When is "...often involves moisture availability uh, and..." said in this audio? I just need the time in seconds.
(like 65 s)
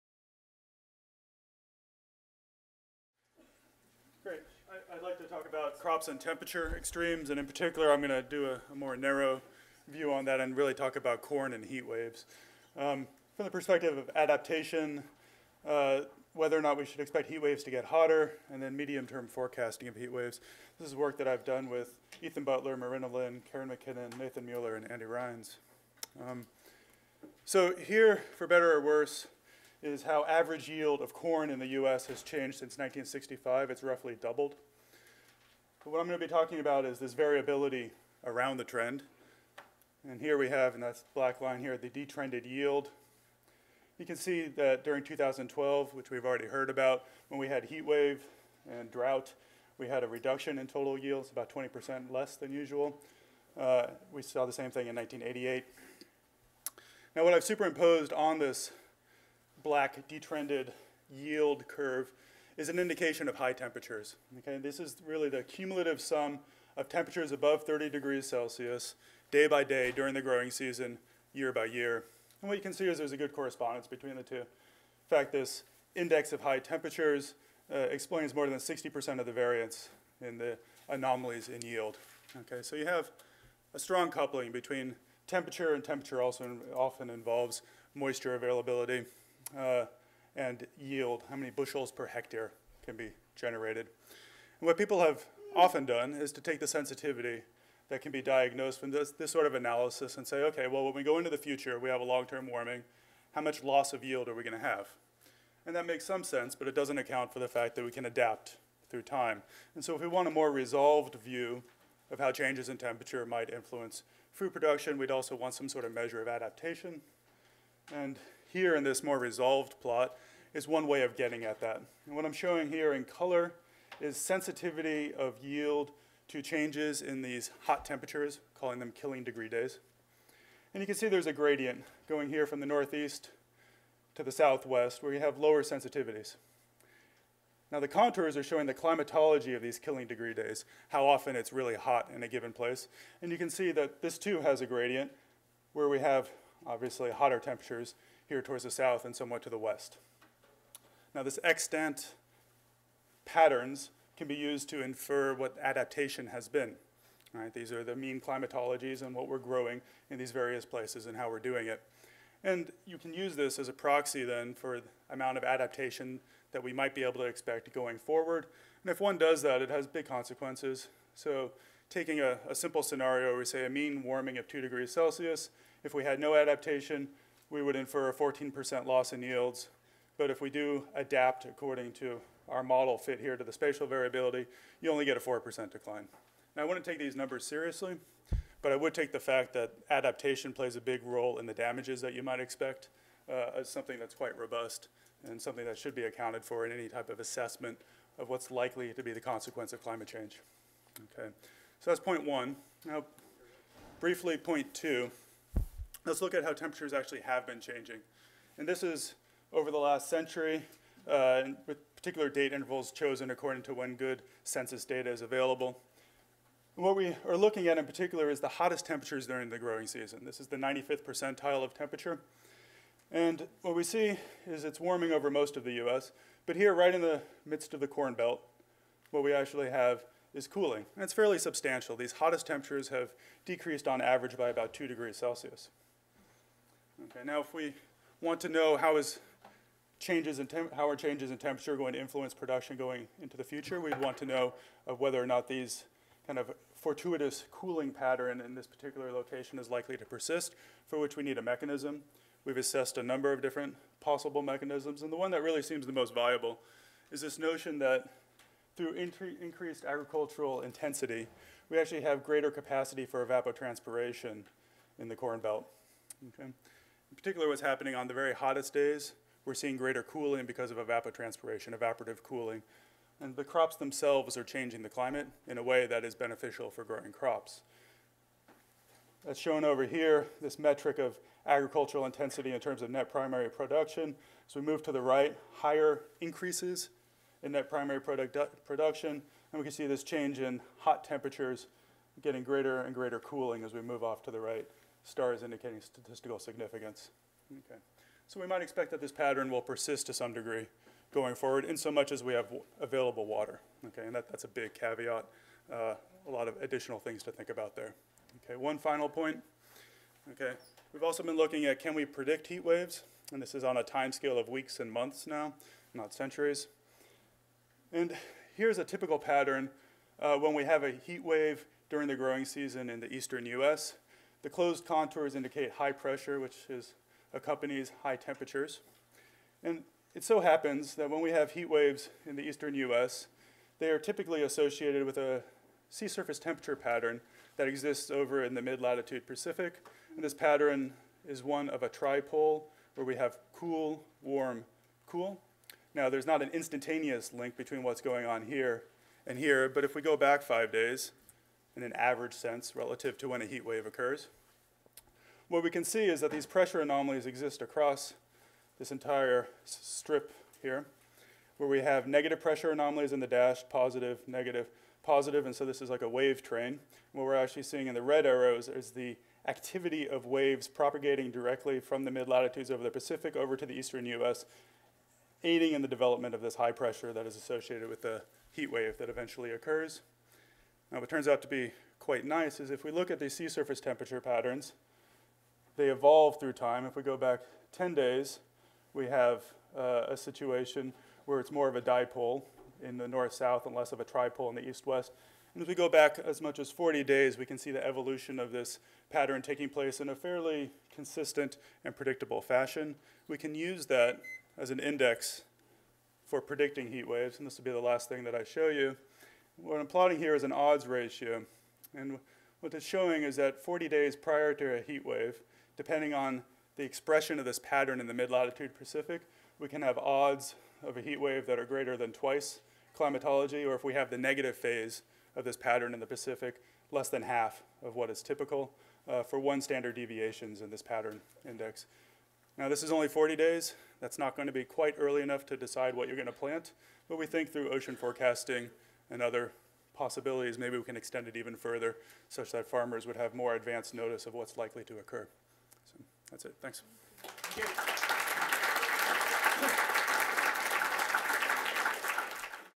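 86 s.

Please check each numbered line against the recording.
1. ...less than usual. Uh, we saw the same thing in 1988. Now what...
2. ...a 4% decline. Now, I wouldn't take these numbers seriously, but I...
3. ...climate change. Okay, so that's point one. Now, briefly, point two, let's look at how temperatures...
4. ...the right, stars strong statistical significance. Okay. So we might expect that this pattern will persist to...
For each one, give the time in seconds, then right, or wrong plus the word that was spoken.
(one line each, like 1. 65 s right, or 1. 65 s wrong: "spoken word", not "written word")
1. 52 s right
2. 185 s right
3. 199 s right
4. 294 s wrong: "indicating", not "strong".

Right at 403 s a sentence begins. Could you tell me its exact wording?
We can use that as an index for predicting heat waves, and this will be the last thing that I show you.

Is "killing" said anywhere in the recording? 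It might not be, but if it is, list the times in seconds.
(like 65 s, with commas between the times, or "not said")
128 s, 139 s.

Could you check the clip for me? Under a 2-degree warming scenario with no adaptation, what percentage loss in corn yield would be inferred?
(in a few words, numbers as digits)
14%.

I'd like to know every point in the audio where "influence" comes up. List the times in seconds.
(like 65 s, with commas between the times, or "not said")
113 s, 241 s.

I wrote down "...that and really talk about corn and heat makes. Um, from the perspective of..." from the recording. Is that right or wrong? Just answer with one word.
wrong.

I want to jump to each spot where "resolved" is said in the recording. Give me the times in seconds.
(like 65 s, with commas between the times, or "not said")
110 s, 119 s.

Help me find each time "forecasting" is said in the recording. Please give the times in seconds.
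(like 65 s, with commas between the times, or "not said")
19 s, 437 s.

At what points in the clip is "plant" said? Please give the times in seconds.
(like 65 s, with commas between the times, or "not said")
436 s.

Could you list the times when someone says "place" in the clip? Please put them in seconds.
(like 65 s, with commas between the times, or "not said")
142 s, 160 s, 399 s.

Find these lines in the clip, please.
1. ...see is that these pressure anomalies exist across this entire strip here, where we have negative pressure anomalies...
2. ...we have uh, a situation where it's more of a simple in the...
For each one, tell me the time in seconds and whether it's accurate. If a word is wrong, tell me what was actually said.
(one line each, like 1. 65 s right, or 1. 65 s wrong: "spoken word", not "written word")
1. 355 s right
2. 388 s wrong: "dipole", not "simple".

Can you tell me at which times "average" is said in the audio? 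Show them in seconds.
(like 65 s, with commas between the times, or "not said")
30 s, 233 s, 351 s.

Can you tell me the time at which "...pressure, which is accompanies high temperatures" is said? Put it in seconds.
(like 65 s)
325 s.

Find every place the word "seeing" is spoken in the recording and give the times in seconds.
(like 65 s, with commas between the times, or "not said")
269 s, 367 s.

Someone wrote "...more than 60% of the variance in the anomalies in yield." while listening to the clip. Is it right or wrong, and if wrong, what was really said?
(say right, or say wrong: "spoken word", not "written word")
right.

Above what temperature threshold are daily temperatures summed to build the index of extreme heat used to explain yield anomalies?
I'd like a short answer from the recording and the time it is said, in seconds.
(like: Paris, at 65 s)
30 degrees Celsius, at 67 s.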